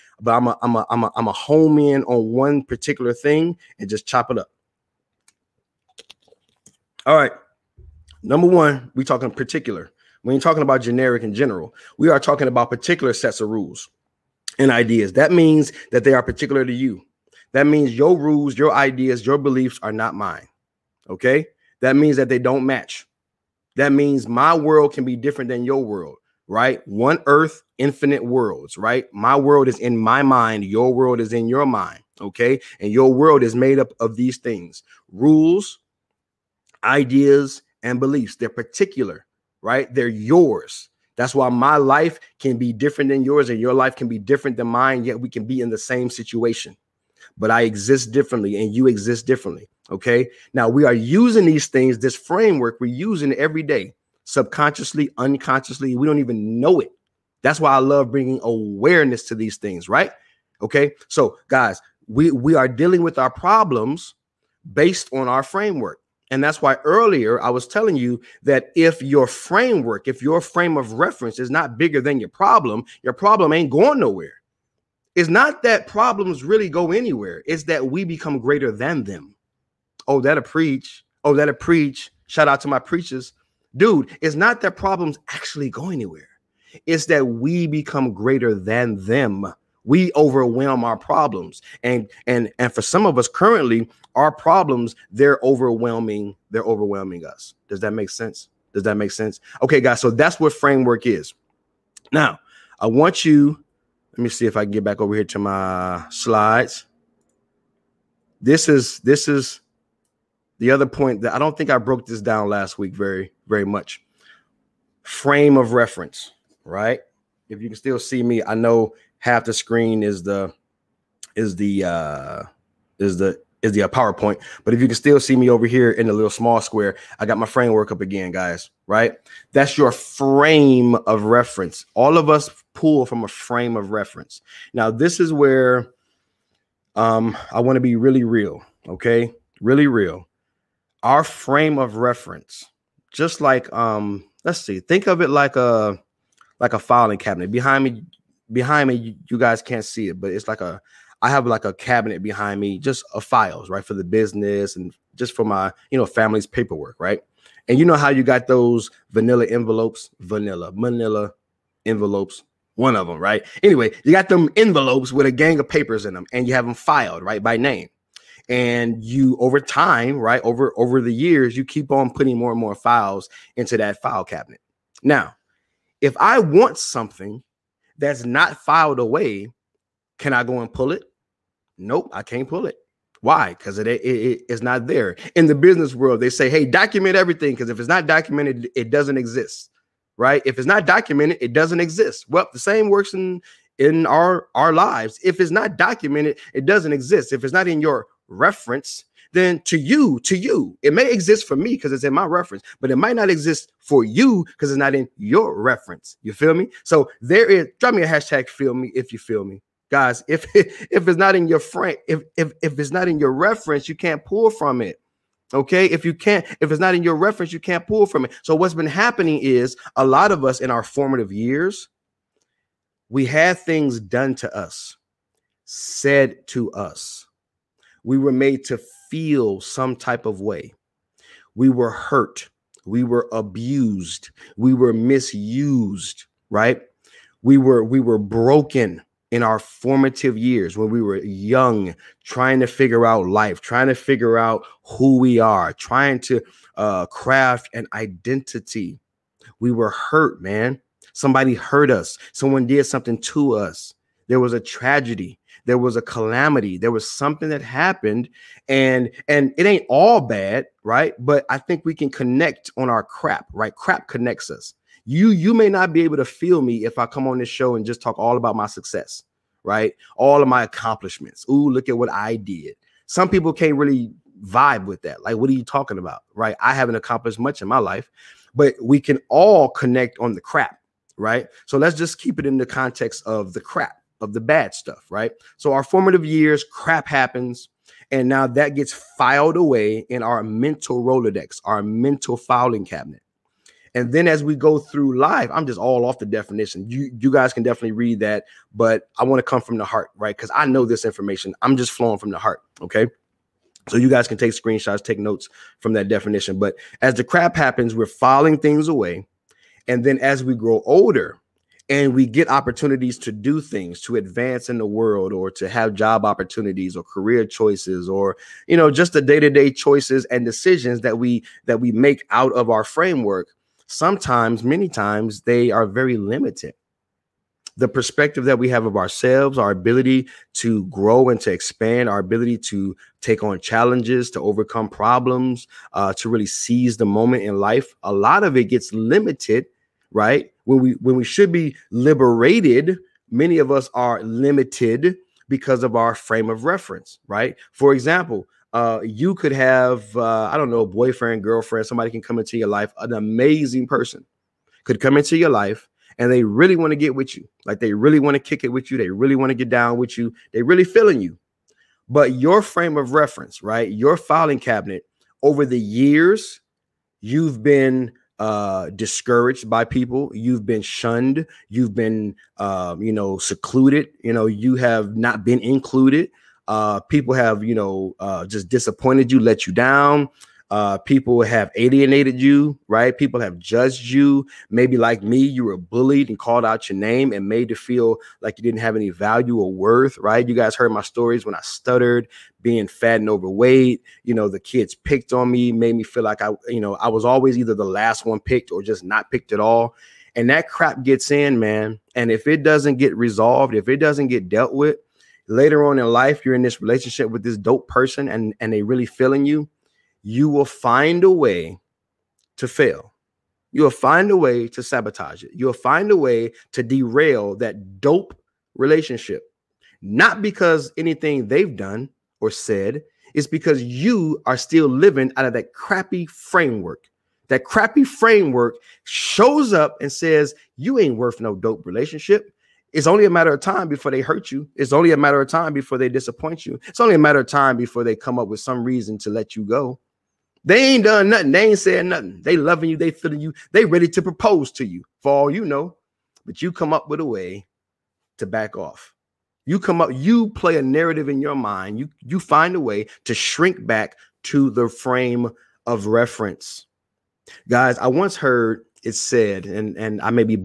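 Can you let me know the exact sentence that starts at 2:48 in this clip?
And you over time, right, over over the years, you keep on putting more and more files into that file cabinet.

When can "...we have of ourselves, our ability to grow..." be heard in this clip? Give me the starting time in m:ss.
5:28.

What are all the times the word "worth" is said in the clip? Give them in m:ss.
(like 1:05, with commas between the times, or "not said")
6:29, 7:11.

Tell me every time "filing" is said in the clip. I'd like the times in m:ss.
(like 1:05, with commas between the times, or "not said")
2:26, 4:52, 5:08, 6:04.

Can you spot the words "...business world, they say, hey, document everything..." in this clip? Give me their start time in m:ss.
3:05.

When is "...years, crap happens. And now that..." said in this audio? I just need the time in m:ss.
4:46.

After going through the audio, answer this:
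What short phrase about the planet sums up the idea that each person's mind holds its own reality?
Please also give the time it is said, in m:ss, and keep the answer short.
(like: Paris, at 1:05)
One earth, infinite worlds, at 0:26.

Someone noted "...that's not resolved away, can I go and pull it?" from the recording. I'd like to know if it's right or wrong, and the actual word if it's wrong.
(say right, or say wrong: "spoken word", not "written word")
wrong: "filed", not "resolved".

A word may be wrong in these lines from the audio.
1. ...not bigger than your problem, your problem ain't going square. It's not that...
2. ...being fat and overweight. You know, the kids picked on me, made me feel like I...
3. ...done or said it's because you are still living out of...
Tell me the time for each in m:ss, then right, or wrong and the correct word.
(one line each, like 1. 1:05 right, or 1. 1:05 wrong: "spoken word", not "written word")
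1. 1:11 wrong: "nowhere", not "square"
2. 6:32 right
3. 7:01 right.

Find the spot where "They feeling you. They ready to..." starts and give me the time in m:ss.
7:22.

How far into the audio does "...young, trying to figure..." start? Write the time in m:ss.
4:01.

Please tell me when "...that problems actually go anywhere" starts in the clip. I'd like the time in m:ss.
1:24.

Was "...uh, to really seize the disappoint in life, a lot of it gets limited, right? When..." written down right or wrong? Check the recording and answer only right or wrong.
wrong.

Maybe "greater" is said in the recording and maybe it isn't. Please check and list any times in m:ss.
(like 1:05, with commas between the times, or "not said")
1:18, 1:28.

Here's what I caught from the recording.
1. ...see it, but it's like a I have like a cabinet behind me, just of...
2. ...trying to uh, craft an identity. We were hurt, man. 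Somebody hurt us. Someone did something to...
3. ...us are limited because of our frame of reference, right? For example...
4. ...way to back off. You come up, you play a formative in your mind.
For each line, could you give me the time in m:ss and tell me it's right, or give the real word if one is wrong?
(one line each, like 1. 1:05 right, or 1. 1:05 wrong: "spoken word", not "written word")
1. 2:29 right
2. 4:05 right
3. 5:43 right
4. 7:27 wrong: "narrative", not "formative".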